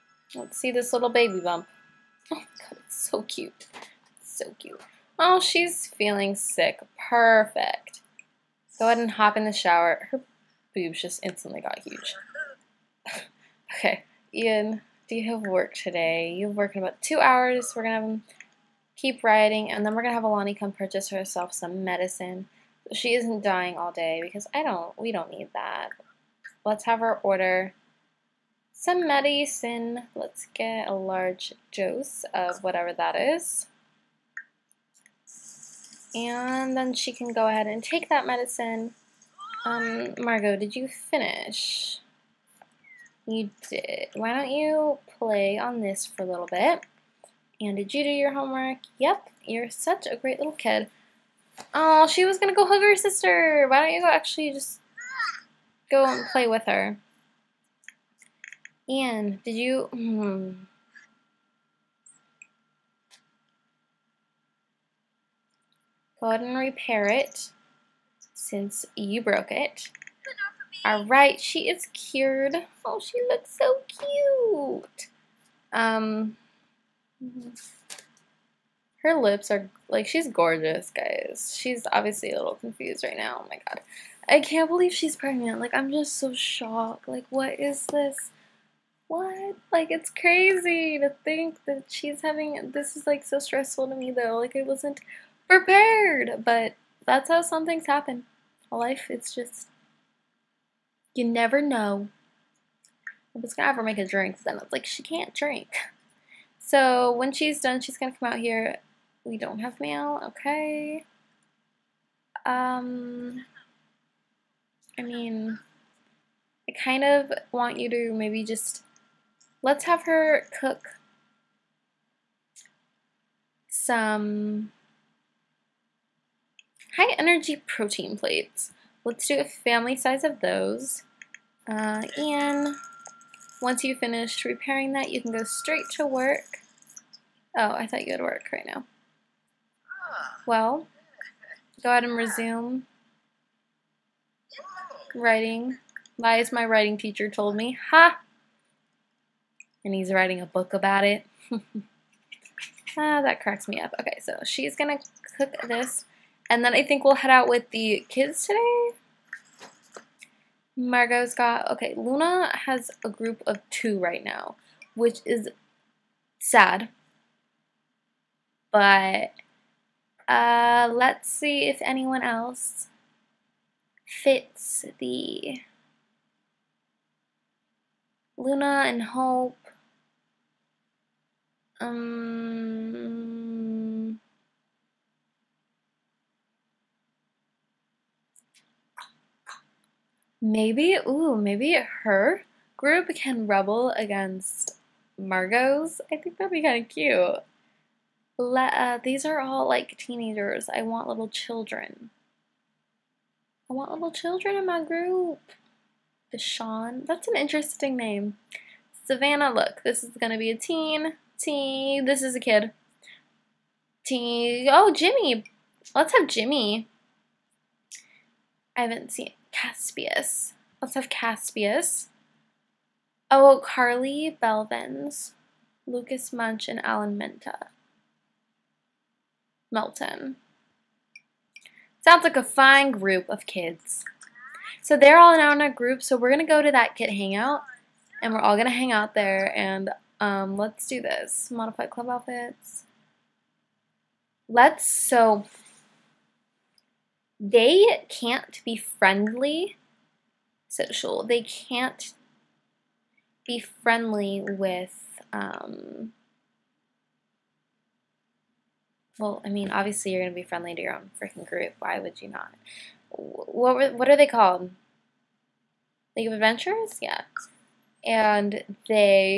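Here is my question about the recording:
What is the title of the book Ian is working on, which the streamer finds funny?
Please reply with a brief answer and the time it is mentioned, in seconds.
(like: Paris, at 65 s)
Lies my writing teacher told me, at 146 s.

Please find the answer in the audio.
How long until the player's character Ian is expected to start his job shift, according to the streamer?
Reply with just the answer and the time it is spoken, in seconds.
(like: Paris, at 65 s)
2 hours, at 17 s.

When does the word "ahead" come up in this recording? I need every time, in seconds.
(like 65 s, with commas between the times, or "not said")
8 s, 37 s, 66 s, 141 s.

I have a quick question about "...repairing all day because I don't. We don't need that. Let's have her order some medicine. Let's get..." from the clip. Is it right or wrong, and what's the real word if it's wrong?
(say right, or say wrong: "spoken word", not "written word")
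wrong: "dying", not "repairing".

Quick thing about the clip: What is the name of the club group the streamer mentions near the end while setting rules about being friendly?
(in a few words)
League of Adventures.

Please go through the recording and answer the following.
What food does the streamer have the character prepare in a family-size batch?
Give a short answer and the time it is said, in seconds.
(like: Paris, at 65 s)
high energy protein plates, at 126 s.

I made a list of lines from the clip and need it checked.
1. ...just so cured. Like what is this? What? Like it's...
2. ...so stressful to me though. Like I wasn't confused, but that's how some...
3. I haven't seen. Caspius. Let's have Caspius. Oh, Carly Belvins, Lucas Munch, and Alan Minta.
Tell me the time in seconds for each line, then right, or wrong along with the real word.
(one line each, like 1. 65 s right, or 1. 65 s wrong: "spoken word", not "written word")
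1. 85 s wrong: "shocked", not "cured"
2. 93 s wrong: "prepared", not "confused"
3. 218 s right.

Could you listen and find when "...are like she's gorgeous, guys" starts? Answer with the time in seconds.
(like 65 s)
79 s.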